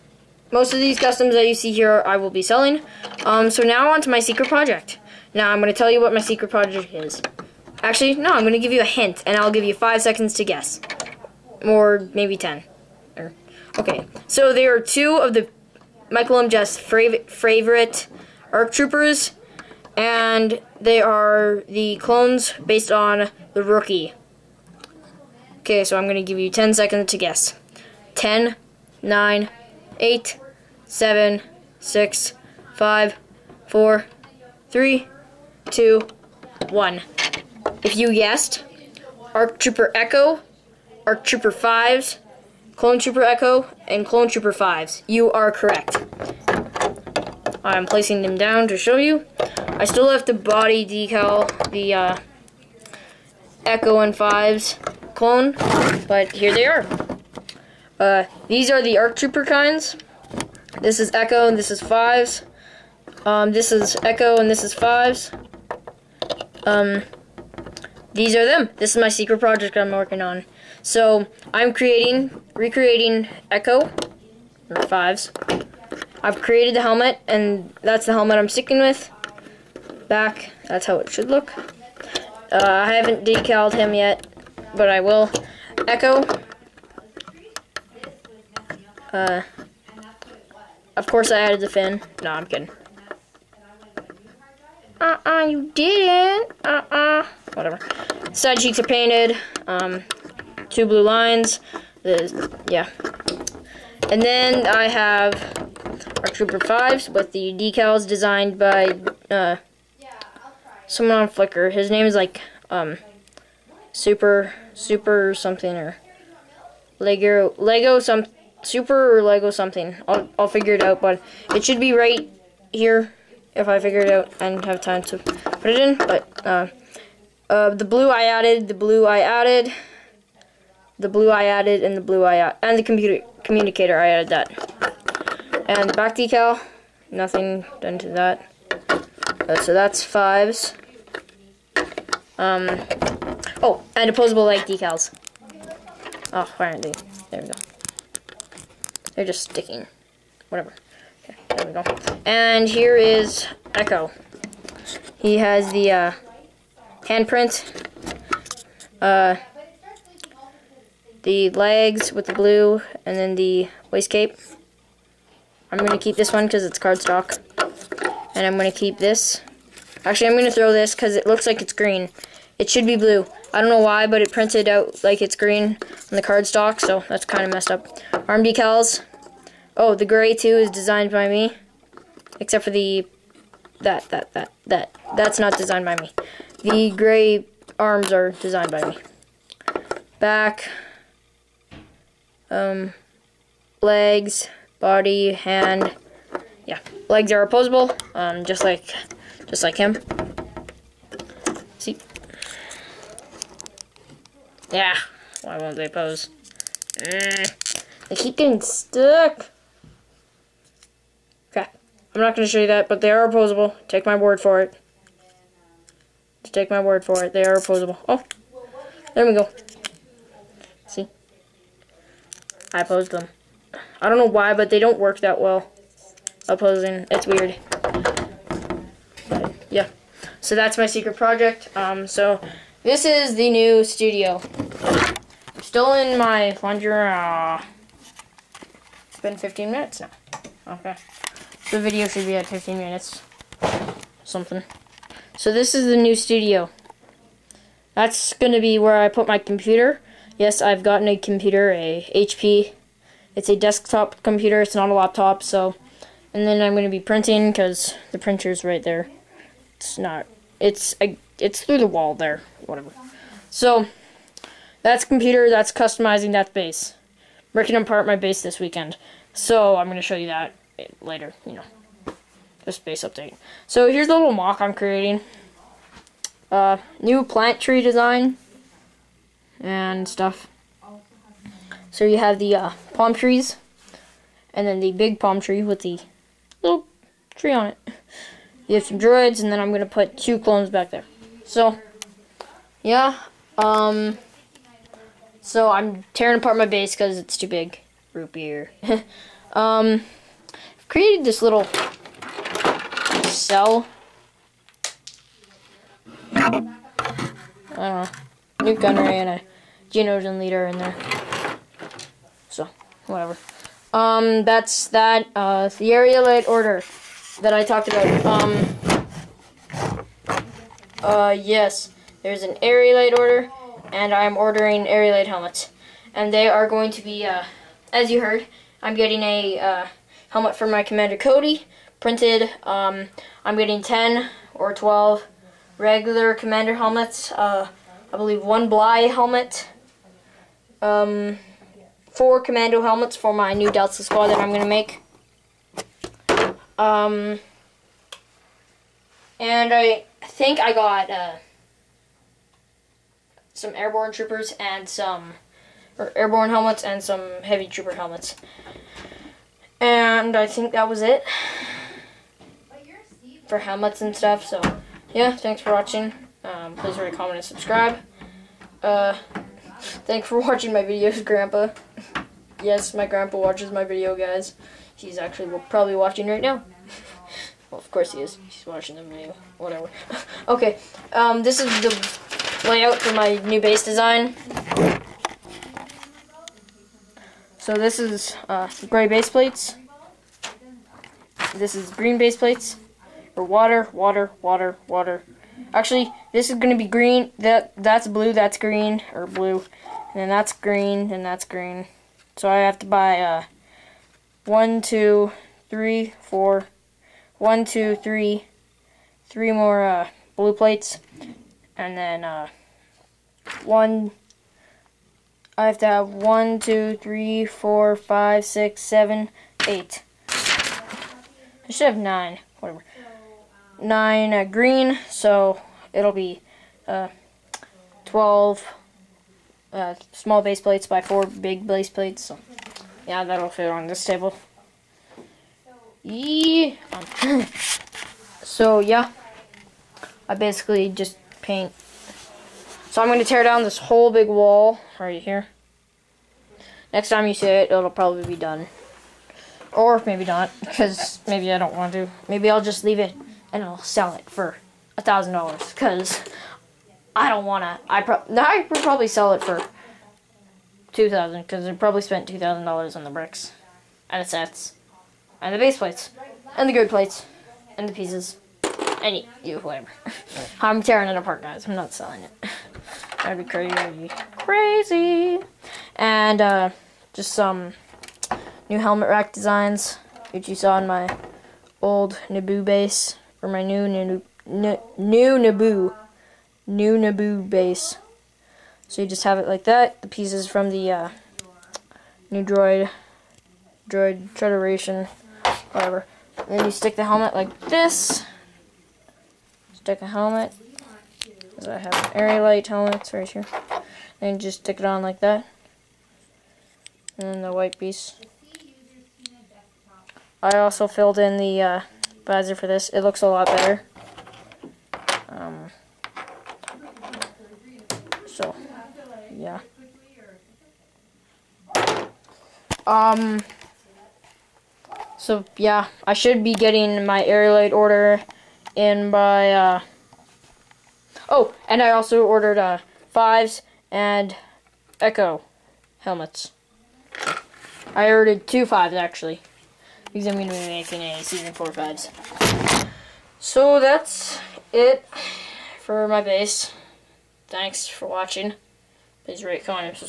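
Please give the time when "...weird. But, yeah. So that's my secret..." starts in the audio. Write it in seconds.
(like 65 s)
227 s.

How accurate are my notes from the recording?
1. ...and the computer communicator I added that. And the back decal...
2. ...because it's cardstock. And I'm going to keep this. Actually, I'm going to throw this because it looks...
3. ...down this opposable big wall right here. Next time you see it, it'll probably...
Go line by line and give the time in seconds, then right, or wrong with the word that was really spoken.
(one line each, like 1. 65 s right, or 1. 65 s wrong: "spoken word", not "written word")
1. 132 s right
2. 166 s right
3. 443 s wrong: "whole", not "opposable".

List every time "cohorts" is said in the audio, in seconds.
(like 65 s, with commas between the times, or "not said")
not said.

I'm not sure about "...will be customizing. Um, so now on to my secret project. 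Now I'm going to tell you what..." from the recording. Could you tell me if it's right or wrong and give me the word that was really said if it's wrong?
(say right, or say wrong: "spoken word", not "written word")
wrong: "selling", not "customizing".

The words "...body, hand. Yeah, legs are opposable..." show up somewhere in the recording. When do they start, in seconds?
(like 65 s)
194 s.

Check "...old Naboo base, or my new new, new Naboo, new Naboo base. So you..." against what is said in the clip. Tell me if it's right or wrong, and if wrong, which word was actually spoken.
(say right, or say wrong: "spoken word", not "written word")
right.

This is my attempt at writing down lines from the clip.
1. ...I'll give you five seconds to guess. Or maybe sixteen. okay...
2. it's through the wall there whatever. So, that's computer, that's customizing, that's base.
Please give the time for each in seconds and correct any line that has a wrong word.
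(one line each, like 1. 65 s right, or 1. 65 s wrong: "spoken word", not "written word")
1. 9 s wrong: "ten", not "sixteen"
2. 261 s right.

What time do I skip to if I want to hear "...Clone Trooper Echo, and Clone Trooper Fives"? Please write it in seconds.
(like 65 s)
42 s.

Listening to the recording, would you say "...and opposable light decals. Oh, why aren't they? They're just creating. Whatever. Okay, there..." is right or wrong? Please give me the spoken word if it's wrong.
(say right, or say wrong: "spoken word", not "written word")
wrong: "sticking", not "creating".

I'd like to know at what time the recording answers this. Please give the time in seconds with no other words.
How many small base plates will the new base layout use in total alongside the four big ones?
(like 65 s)
428 s.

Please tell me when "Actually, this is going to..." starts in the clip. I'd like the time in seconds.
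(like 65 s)
395 s.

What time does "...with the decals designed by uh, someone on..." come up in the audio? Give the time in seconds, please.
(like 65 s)
107 s.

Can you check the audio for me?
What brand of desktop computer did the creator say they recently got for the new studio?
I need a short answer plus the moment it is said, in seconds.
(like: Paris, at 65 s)
HP, at 252 s.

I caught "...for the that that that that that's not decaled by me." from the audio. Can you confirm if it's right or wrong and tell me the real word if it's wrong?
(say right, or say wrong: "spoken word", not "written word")
wrong: "designed", not "decaled".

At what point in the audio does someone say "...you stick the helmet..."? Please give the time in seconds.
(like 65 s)
496 s.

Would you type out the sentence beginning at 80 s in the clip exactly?
Back, that's how it should look.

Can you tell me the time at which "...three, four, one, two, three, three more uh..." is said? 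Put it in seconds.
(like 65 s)
405 s.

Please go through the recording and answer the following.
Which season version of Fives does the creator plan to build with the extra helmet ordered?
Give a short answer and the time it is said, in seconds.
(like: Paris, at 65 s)
Season 4, at 541 s.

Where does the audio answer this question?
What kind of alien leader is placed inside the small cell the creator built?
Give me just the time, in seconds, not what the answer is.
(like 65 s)
309 s.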